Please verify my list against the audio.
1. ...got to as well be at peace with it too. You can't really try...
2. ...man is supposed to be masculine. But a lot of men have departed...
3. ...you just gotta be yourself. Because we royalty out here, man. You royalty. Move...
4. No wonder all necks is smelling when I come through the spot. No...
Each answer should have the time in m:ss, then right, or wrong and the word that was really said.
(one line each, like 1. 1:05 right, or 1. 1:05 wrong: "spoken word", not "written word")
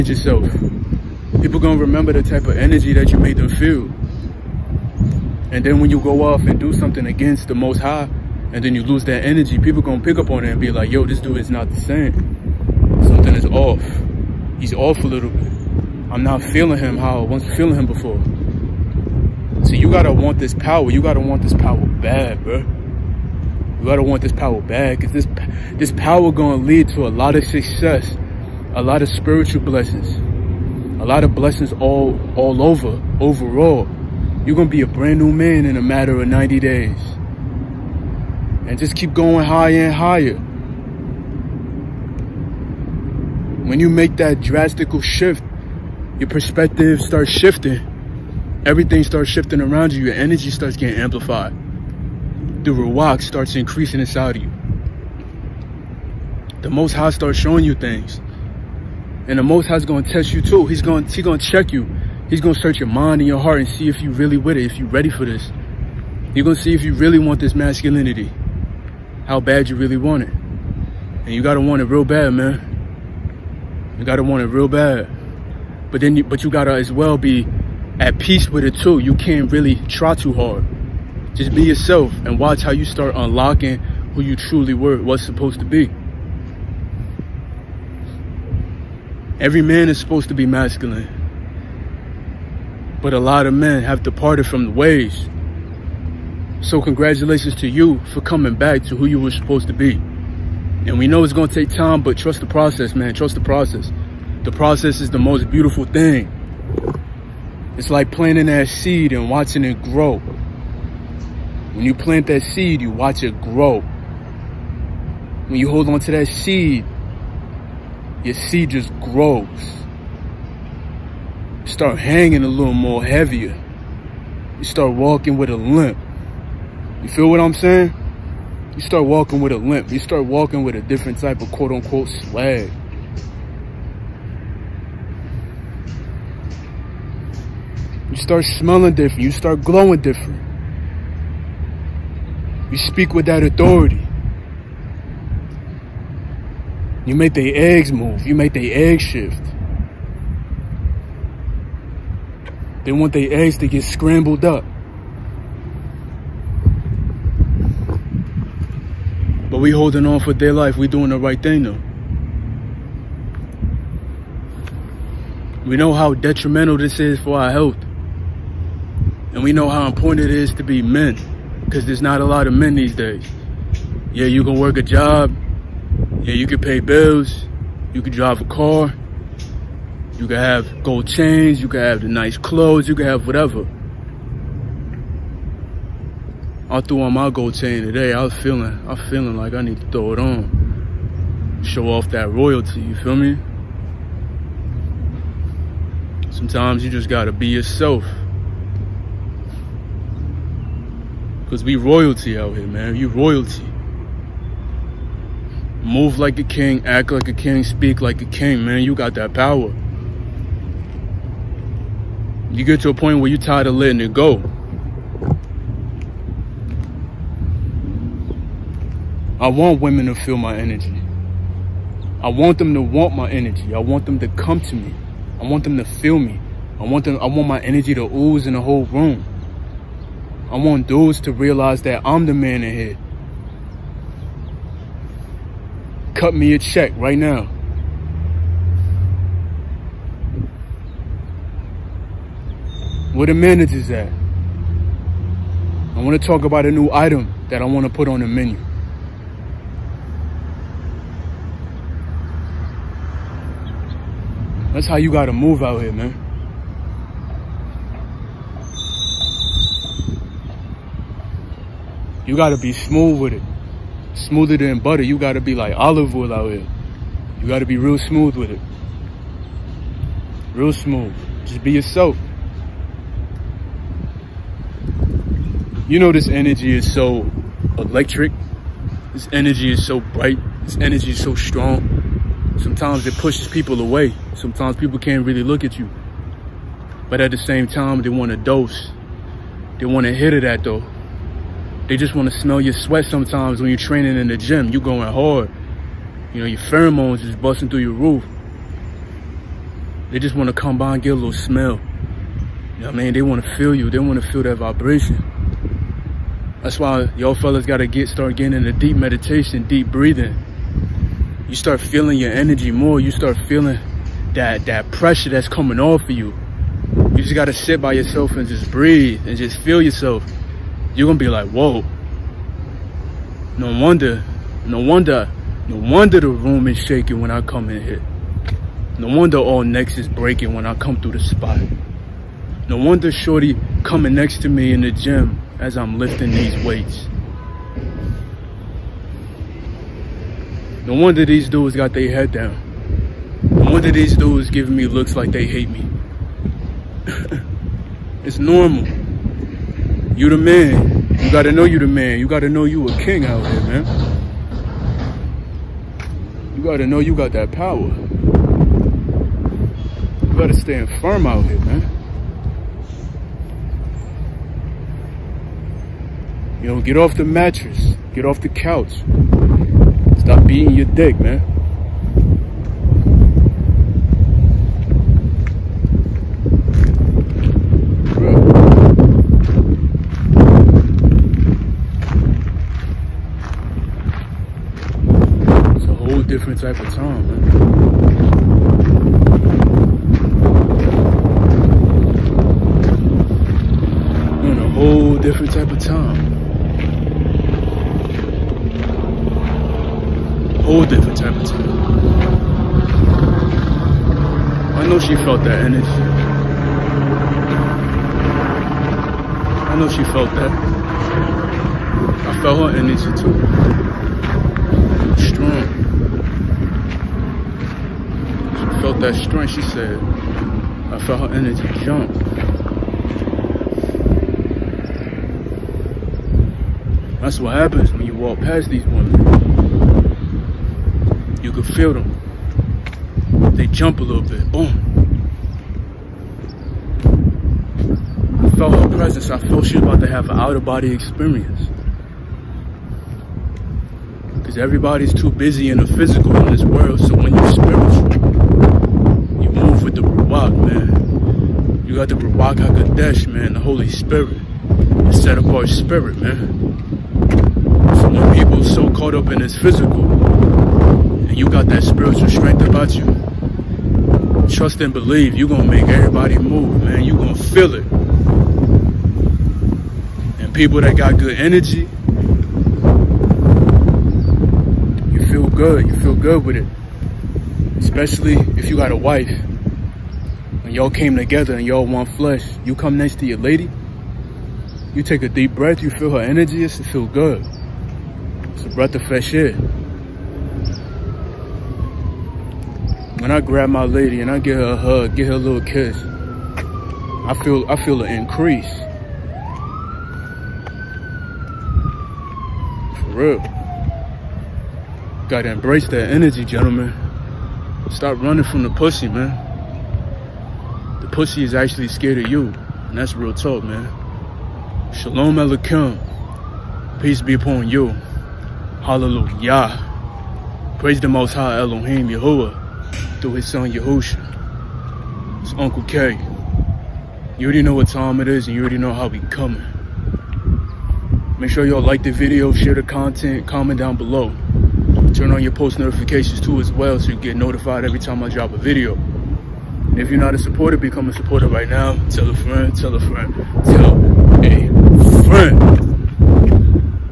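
1. 1:16 right
2. 1:29 right
3. 3:16 right
4. 5:28 wrong: "breaking", not "smelling".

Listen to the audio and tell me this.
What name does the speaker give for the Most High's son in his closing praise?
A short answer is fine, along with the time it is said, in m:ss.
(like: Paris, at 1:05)
Yahusha, at 8:43.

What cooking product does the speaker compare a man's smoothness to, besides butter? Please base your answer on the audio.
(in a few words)
olive oil.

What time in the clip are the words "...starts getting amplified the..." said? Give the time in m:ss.
0:50.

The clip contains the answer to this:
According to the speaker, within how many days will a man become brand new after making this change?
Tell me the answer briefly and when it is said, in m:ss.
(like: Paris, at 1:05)
90, at 0:36.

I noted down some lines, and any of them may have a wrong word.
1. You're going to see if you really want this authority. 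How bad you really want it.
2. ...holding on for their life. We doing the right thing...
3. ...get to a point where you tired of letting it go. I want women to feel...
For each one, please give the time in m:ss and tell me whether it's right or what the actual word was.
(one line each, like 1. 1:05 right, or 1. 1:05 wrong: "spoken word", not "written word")
1. 1:06 wrong: "masculinity", not "authority"
2. 2:39 right
3. 3:32 right.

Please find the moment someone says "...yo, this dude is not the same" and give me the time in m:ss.
0:10.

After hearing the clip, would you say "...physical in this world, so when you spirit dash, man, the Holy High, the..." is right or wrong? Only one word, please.
wrong.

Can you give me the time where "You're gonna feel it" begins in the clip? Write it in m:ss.
7:47.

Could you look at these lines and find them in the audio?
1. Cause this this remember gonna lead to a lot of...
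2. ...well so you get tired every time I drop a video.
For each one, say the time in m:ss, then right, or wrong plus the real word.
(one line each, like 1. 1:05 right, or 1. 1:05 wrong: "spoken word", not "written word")
1. 0:25 wrong: "power", not "remember"
2. 8:56 wrong: "notified", not "tired".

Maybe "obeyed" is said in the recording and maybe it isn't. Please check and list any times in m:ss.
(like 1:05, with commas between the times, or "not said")
not said.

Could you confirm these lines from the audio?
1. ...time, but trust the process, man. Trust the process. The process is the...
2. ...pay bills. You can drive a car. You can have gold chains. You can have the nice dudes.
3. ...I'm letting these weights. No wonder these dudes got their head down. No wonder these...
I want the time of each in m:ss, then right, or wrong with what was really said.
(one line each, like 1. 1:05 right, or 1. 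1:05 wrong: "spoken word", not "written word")
1. 1:41 right
2. 2:56 wrong: "clothes", not "dudes"
3. 5:35 wrong: "lifting", not "letting".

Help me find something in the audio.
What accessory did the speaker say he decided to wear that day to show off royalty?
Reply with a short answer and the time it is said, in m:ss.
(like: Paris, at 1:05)
gold chain, at 3:07.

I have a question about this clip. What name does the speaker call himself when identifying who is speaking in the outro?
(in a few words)
Uncle K.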